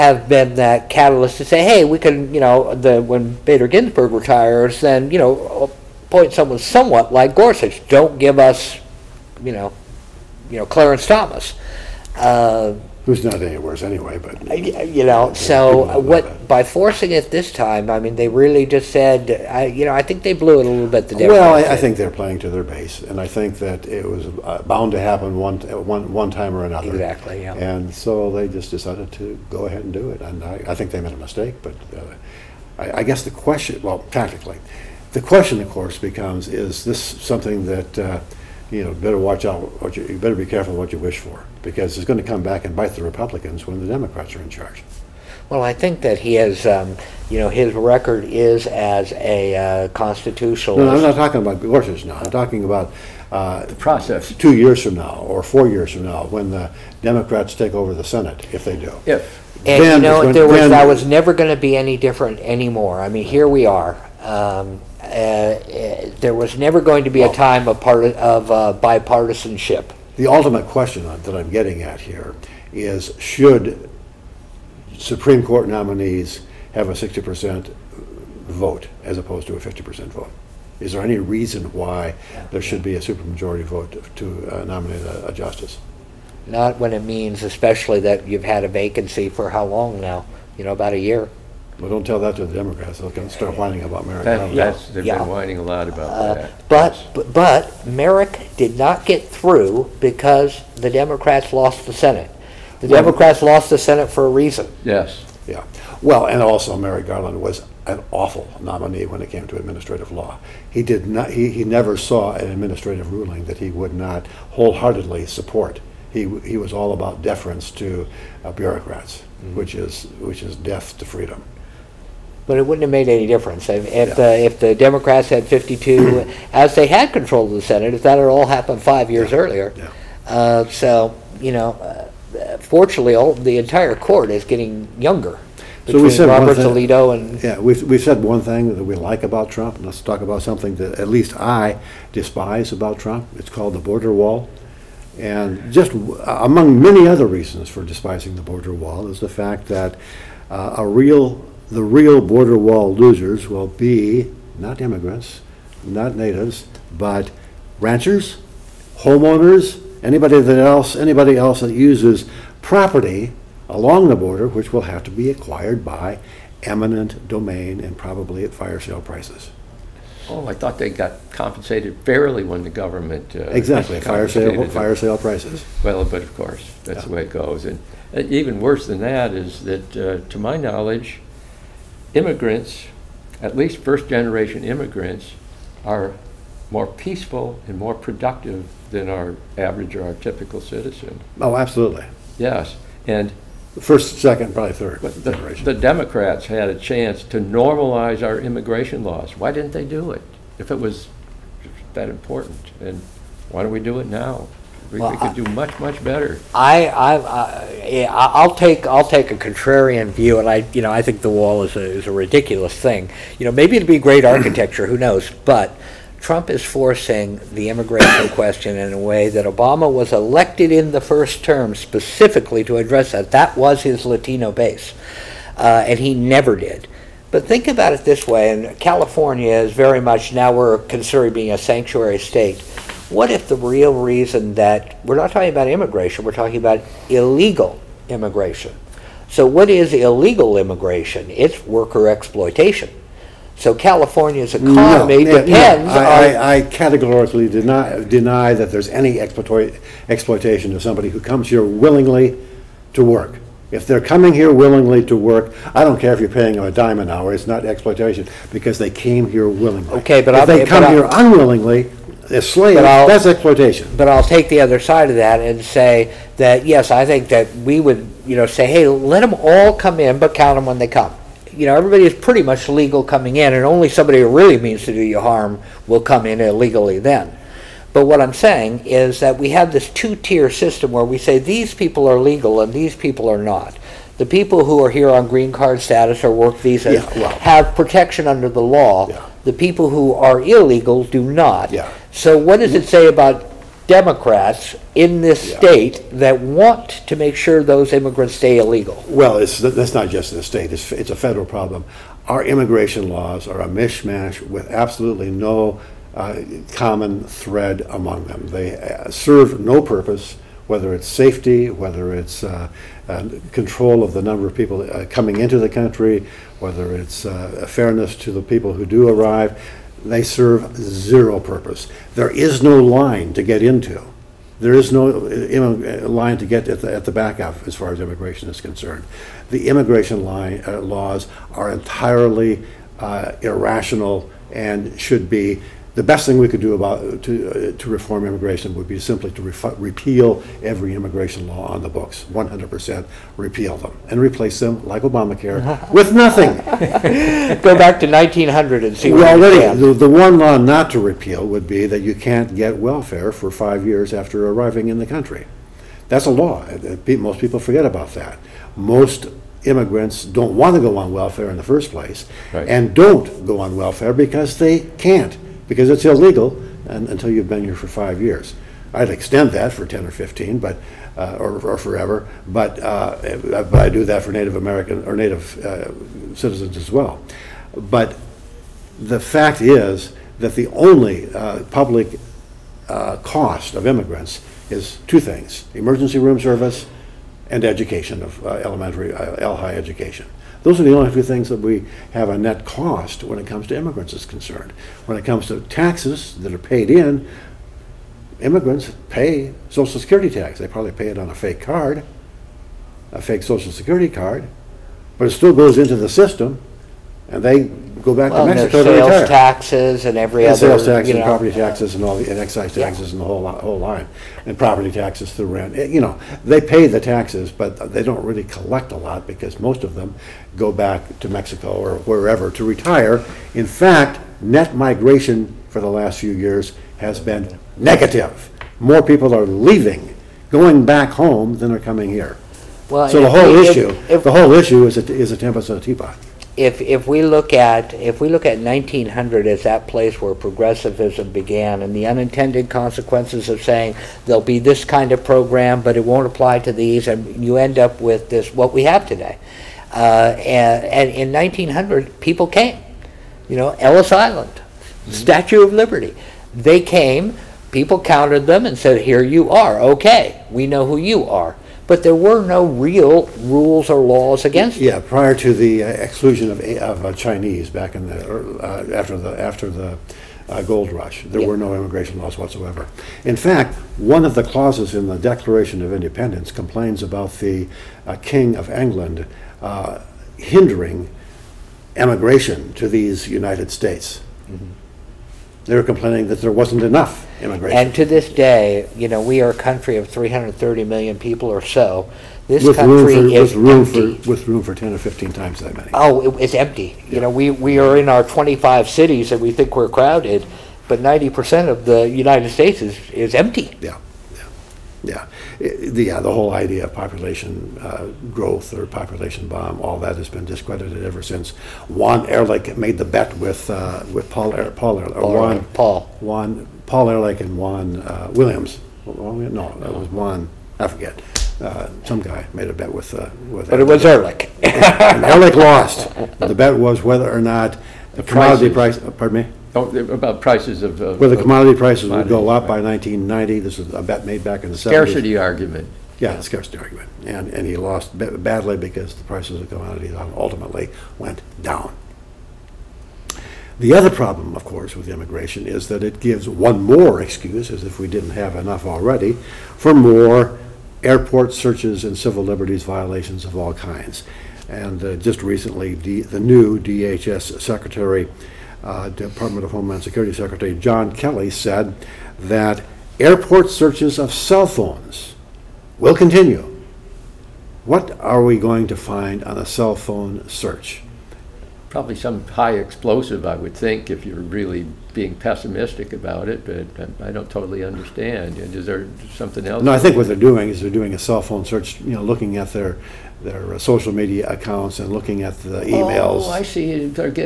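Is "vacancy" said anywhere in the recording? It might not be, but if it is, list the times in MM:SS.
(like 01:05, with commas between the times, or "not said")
01:28.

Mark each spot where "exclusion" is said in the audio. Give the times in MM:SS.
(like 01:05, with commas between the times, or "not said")
07:45.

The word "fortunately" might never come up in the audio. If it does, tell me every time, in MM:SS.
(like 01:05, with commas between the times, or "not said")
02:12.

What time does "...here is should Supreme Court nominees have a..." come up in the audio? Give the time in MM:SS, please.
01:11.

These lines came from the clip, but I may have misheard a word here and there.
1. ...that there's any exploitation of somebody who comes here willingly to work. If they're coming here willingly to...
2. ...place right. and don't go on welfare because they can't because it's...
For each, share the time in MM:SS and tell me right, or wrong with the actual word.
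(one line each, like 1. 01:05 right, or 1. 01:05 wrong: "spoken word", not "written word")
1. 04:08 right
2. 06:01 right.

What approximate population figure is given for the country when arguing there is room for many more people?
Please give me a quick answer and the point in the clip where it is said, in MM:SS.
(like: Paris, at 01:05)
330 million, at 08:10.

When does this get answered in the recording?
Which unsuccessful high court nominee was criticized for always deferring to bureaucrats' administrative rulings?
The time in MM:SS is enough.
01:46.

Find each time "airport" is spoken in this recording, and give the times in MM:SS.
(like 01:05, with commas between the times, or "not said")
09:11, 09:23.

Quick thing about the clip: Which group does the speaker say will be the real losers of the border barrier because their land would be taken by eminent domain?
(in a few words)
Ranchers.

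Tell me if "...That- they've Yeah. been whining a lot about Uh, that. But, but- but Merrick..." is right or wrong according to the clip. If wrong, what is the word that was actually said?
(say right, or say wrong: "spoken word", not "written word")
right.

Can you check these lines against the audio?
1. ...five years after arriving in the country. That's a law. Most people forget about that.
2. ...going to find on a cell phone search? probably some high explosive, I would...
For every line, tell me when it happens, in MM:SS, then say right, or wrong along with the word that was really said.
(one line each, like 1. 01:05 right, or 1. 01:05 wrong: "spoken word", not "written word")
1. 05:53 right
2. 09:28 right.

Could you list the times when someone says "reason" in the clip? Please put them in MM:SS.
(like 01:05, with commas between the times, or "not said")
01:21, 01:44, 02:27, 03:53.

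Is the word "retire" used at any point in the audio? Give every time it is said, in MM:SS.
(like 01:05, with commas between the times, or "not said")
00:04, 06:49, 07:02.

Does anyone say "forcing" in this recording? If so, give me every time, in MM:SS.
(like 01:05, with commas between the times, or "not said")
00:16, 03:36.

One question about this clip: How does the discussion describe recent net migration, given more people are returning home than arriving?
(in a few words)
Negative.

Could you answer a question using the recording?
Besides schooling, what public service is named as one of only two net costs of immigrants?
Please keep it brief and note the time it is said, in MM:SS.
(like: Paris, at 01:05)
Emergency room service, at 06:25.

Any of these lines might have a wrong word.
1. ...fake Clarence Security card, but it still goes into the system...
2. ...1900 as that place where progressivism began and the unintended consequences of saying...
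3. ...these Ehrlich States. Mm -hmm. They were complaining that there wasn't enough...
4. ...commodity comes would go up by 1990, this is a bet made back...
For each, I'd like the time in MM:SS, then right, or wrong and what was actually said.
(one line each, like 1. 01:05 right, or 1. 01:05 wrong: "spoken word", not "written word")
1. 06:43 wrong: "Social", not "Clarence"
2. 07:18 right
3. 08:02 wrong: "United", not "Ehrlich"
4. 08:51 wrong: "prices", not "comes".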